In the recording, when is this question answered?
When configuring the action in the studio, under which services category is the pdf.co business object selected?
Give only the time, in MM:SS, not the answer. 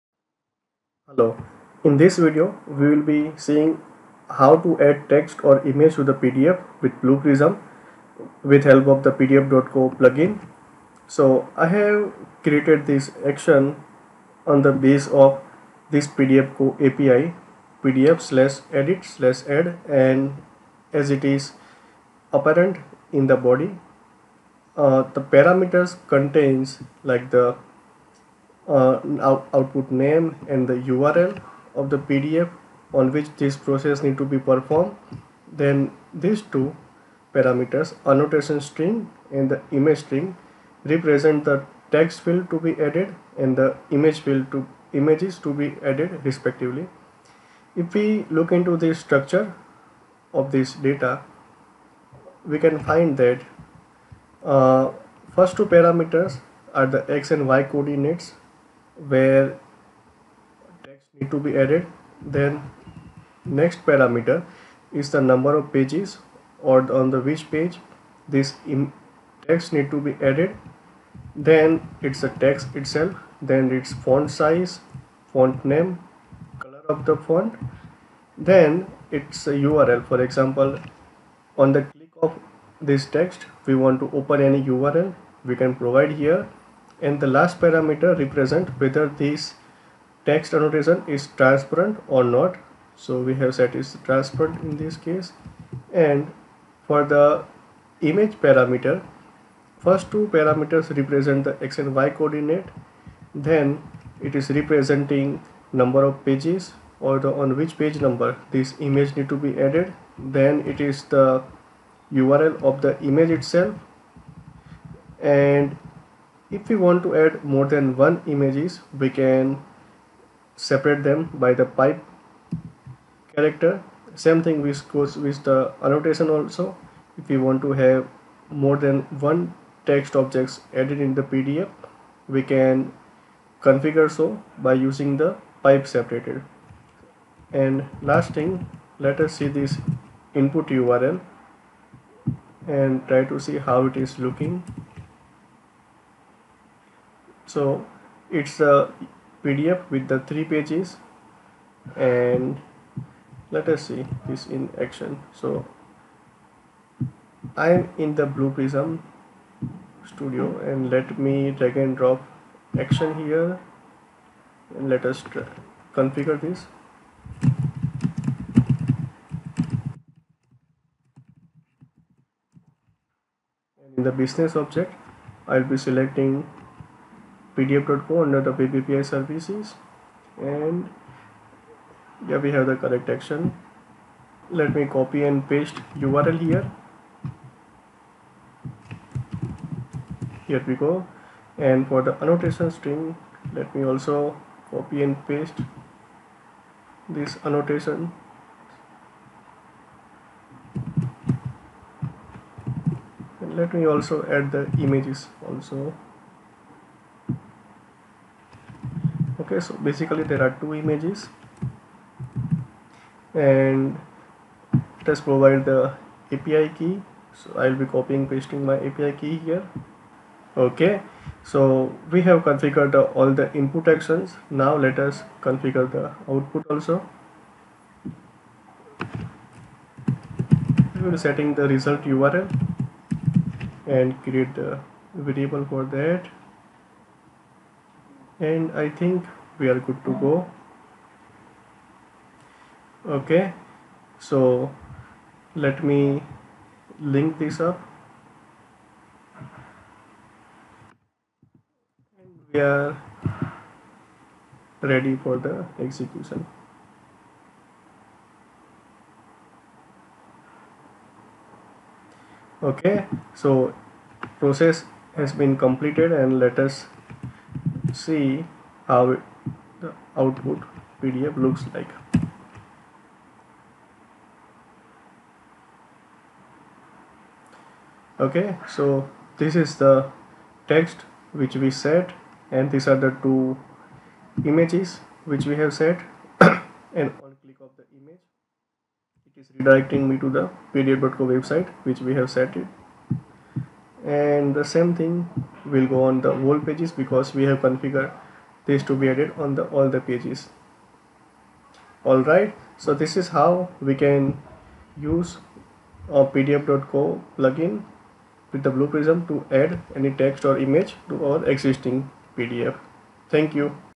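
02:58.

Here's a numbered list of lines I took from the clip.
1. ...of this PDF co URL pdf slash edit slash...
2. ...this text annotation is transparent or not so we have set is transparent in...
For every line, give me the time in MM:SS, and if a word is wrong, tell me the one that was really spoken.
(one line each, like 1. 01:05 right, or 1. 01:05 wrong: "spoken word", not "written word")
1. 00:15 wrong: "API", not "URL"
2. 01:29 right.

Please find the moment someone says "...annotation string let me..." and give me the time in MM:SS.
03:12.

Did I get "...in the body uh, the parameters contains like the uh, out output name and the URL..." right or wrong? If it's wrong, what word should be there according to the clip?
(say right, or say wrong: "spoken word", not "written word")
right.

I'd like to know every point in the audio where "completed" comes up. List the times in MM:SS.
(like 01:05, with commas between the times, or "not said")
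04:25.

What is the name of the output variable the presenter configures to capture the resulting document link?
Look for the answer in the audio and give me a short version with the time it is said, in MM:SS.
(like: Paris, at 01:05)
result URL, at 03:51.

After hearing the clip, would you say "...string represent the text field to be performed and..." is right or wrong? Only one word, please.
wrong.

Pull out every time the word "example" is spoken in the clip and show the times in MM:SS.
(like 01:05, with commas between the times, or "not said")
01:20.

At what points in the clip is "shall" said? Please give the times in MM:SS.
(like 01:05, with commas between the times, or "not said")
not said.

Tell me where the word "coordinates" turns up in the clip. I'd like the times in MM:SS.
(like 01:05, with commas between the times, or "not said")
00:57, 01:42.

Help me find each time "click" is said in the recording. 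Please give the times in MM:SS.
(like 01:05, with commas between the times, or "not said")
01:21, 04:47.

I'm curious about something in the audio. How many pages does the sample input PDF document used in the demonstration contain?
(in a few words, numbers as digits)
3.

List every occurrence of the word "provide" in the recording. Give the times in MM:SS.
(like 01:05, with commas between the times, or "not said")
01:25, 03:35.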